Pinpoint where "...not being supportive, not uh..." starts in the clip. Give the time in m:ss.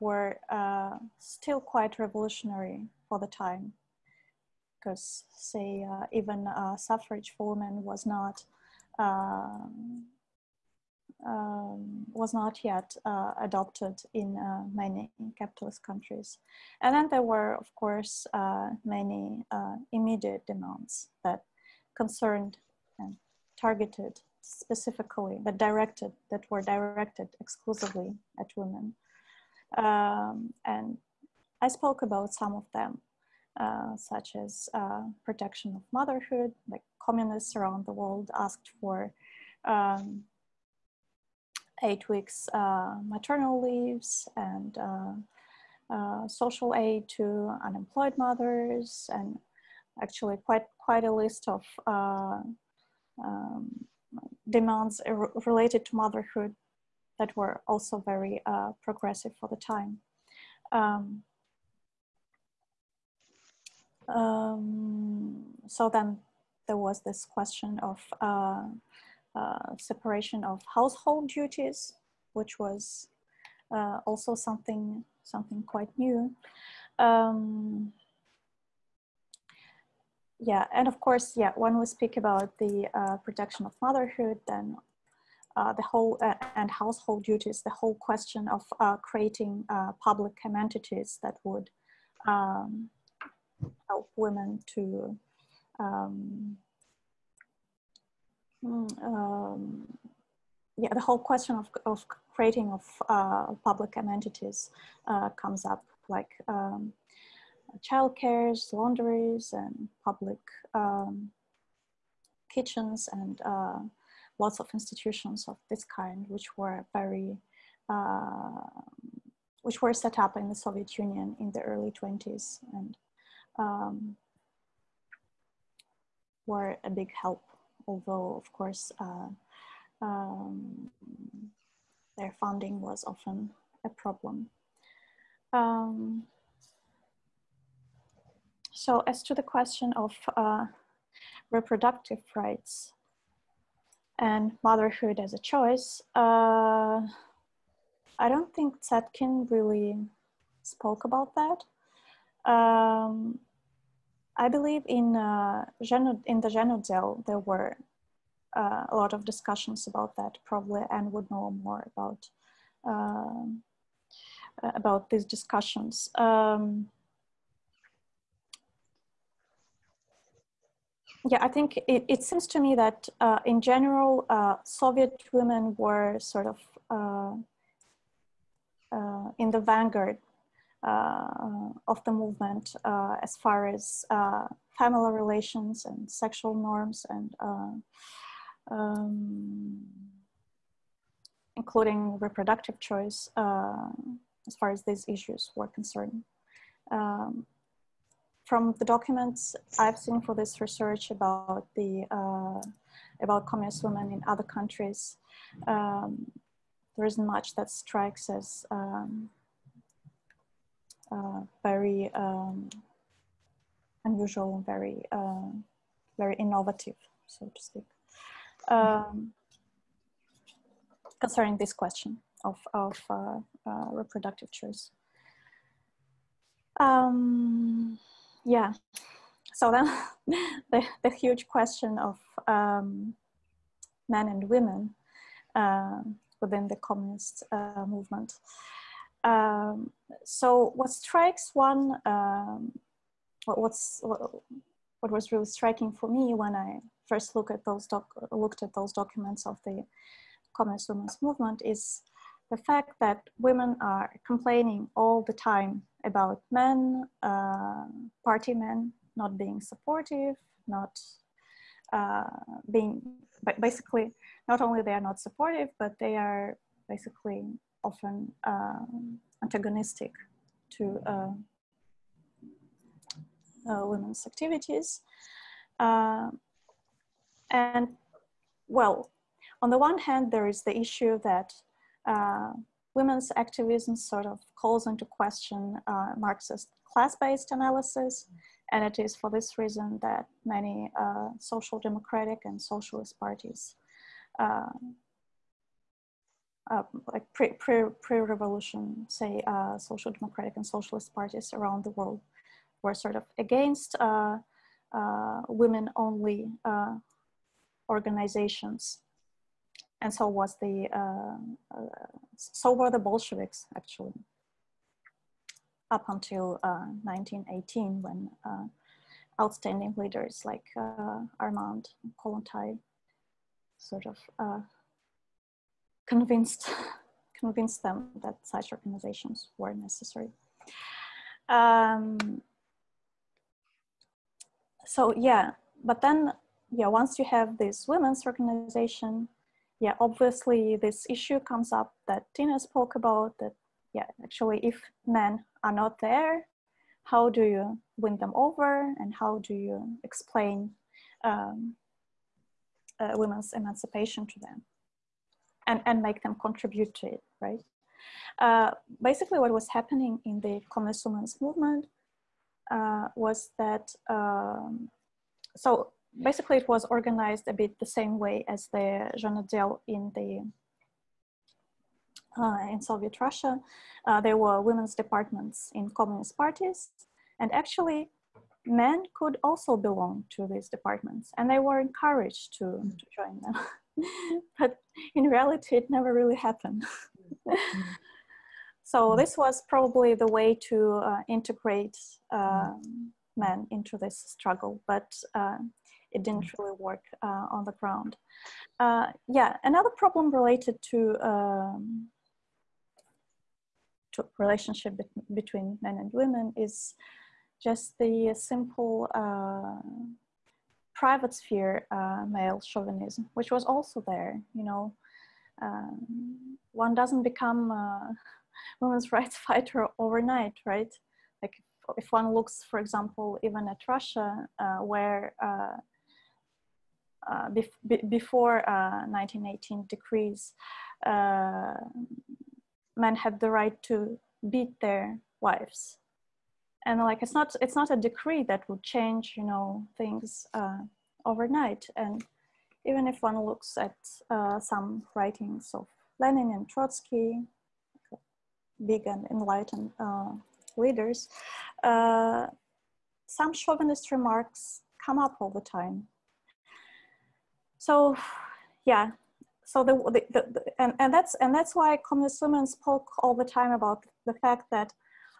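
4:19.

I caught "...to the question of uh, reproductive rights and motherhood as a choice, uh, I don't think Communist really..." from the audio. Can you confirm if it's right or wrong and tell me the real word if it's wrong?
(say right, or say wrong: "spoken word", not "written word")
wrong: "Zetkin", not "Communist".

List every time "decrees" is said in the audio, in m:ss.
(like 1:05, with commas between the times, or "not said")
7:09, 7:17.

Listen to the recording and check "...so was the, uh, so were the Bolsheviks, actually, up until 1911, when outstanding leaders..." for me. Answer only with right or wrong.
wrong.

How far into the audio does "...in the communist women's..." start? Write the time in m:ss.
6:00.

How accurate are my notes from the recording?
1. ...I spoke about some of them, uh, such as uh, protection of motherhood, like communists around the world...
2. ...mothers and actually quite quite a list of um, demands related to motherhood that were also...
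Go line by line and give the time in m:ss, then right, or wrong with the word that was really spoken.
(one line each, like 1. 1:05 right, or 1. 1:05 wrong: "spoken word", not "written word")
1. 0:31 right
2. 0:48 right.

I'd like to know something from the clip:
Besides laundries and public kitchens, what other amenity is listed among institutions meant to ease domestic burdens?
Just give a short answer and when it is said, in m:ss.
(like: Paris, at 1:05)
cares, at 1:48.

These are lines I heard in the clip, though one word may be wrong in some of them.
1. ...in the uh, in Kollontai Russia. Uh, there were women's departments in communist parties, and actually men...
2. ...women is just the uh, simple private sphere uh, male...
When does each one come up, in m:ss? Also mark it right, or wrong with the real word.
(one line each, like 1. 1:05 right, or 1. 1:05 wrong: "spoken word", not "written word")
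1. 6:09 wrong: "Soviet", not "Kollontai"
2. 6:46 right.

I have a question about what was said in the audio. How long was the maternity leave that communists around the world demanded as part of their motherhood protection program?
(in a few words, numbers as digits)
8 weeks.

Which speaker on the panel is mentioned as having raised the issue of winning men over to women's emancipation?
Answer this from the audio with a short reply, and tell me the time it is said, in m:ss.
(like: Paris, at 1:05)
Tina, at 5:42.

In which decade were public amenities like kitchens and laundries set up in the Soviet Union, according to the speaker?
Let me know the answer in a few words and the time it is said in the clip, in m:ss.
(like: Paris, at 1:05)
early 20s, at 2:01.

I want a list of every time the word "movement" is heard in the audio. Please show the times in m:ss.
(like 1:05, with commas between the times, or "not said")
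3:02, 3:57, 4:11, 6:01.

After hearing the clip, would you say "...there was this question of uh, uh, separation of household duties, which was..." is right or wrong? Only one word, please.
right.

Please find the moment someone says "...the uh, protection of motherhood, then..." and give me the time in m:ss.
1:22.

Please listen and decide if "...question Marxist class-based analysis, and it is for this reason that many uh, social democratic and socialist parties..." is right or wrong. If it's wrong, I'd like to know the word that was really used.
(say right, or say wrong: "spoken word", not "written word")
right.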